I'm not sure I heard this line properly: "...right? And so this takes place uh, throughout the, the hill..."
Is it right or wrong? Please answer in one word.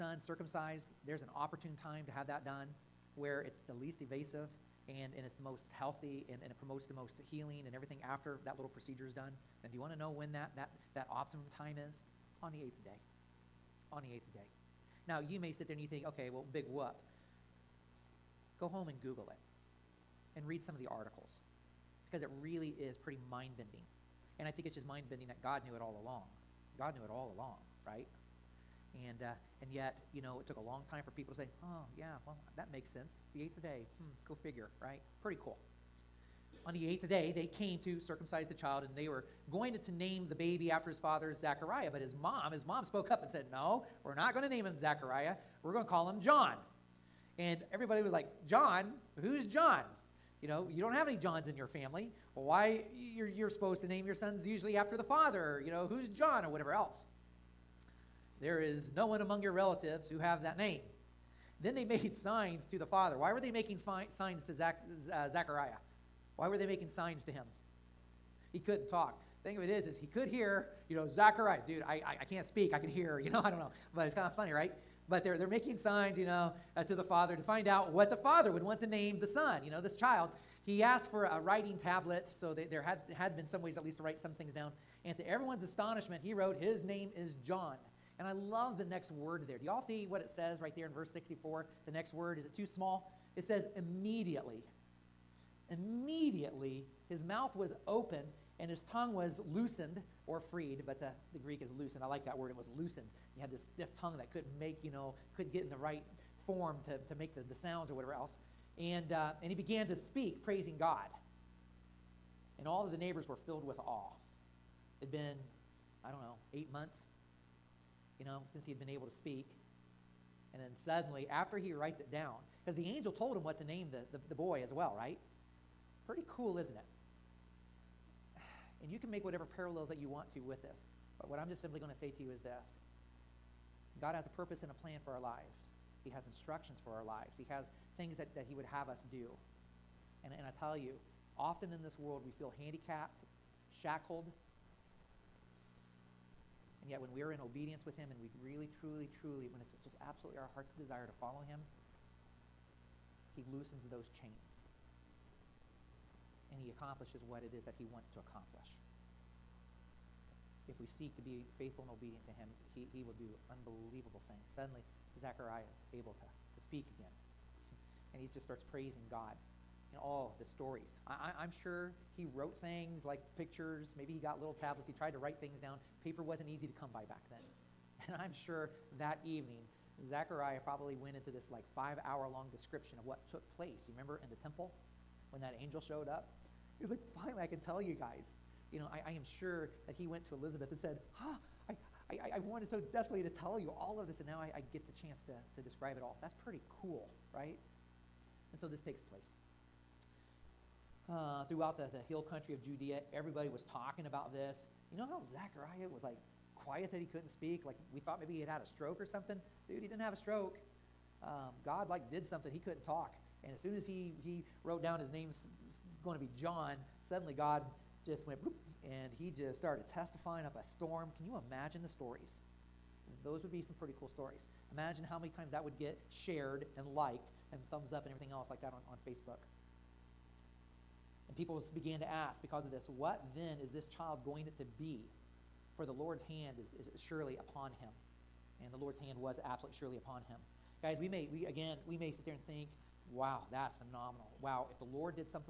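right.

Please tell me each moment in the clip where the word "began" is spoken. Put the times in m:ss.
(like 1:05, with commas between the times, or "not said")
1:49, 3:51.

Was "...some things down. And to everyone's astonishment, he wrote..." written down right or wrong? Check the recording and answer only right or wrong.
right.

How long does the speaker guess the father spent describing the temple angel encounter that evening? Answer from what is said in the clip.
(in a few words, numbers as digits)
5 hours.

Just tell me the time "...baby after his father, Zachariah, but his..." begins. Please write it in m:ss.
0:40.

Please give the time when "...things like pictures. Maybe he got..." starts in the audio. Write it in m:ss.
2:52.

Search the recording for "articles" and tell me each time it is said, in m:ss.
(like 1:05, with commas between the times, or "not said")
0:20.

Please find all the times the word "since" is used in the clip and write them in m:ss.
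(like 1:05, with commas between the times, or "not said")
1:58.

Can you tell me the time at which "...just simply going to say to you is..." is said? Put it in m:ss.
2:11.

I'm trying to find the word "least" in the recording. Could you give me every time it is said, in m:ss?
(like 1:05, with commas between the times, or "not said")
0:03, 1:23.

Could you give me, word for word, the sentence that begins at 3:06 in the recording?
He's like, finally, I can tell you guys.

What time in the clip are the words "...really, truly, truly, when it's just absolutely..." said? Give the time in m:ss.
2:28.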